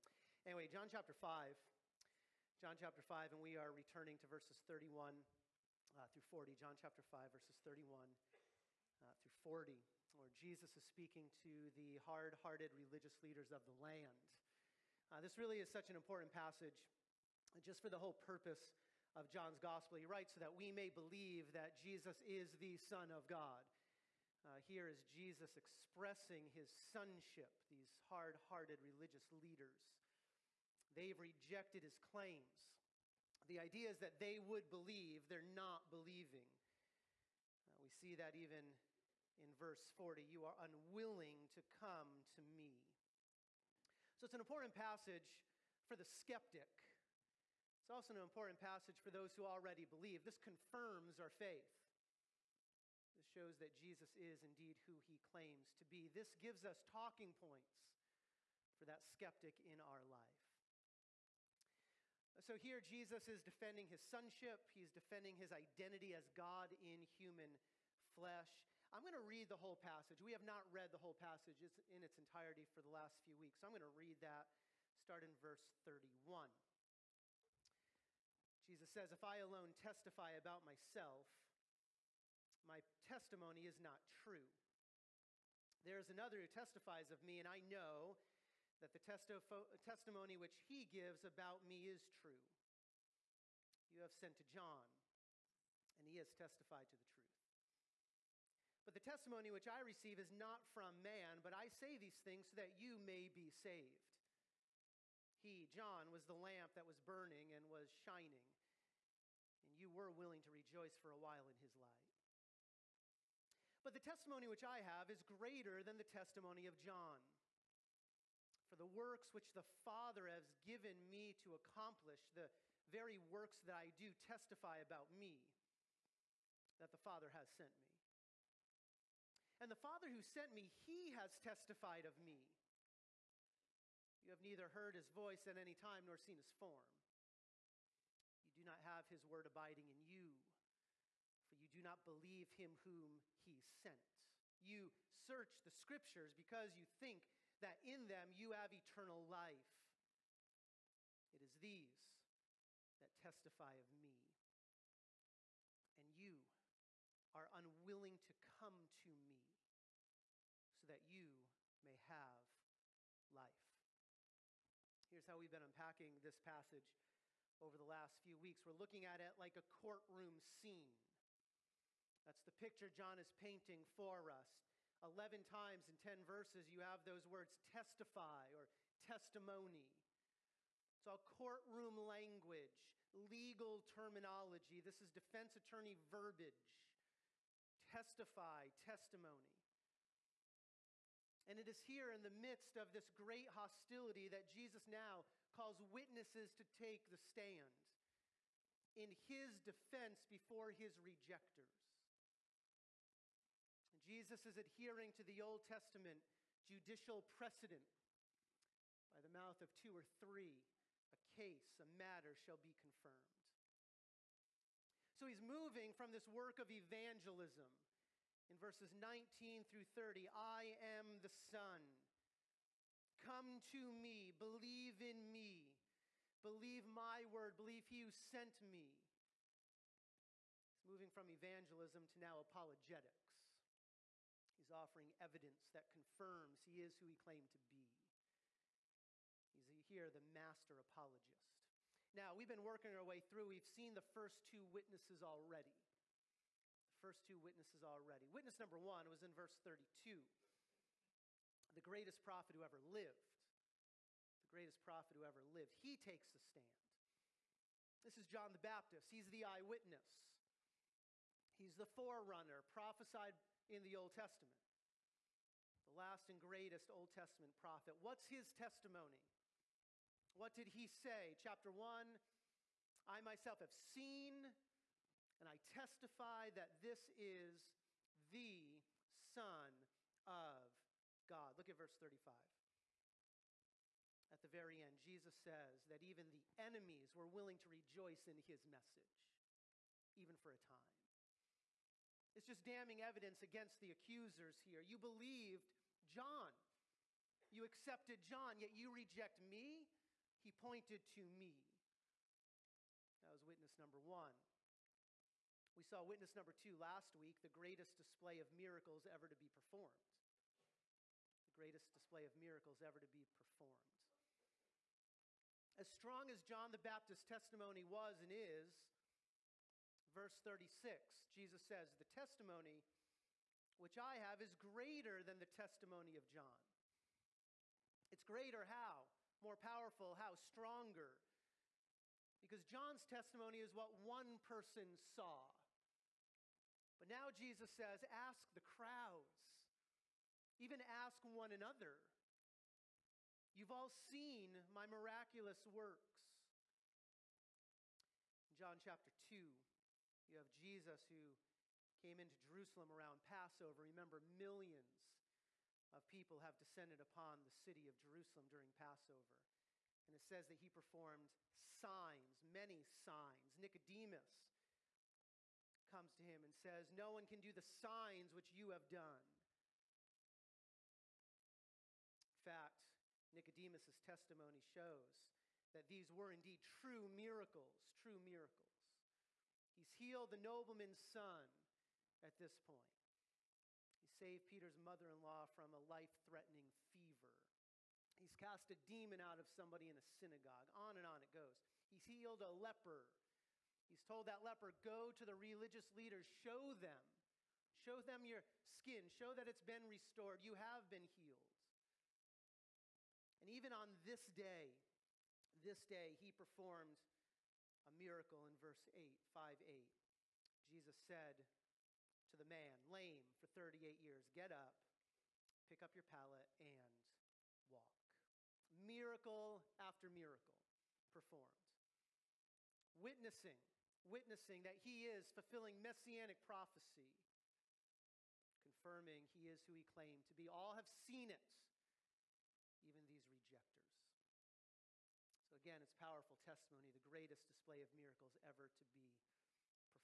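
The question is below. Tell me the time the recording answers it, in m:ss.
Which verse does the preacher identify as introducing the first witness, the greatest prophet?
4:09.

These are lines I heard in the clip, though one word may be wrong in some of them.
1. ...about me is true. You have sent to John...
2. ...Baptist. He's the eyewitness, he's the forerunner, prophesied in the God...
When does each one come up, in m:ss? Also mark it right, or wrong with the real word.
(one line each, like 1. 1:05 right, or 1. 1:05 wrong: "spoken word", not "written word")
1. 1:31 right
2. 4:18 wrong: "Old", not "God".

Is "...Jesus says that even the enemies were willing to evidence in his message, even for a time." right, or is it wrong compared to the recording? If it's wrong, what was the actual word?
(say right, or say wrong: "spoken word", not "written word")
wrong: "rejoice", not "evidence".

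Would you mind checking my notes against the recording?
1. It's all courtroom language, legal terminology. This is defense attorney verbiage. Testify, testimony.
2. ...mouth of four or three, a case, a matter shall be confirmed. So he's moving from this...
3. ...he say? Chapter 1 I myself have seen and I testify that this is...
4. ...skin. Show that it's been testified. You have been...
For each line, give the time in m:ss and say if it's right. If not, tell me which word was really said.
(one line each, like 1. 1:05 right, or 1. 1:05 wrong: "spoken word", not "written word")
1. 3:00 right
2. 3:29 wrong: "two", not "four"
3. 4:30 right
4. 6:38 wrong: "restored", not "testified".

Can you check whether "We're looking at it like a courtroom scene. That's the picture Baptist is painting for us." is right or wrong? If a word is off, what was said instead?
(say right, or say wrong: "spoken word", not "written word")
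wrong: "John", not "Baptist".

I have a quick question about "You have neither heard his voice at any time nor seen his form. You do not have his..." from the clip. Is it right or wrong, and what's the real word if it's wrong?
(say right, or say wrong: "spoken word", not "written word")
right.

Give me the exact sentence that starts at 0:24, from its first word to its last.
Uh, here is Jesus expressing his sonship, these hard hearted religious leaders.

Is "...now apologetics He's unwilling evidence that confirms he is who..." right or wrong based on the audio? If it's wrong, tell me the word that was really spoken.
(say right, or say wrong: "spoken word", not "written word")
wrong: "offering", not "unwilling".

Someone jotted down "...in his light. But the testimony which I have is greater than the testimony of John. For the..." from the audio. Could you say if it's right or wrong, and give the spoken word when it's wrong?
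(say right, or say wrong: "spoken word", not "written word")
right.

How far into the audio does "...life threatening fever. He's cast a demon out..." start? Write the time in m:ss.
6:25.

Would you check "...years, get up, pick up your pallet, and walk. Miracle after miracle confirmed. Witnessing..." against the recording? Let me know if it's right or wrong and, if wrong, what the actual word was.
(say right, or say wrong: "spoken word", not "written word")
wrong: "performed", not "confirmed".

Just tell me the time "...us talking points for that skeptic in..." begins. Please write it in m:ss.
0:56.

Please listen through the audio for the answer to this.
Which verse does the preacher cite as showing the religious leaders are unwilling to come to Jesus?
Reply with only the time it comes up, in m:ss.
0:39.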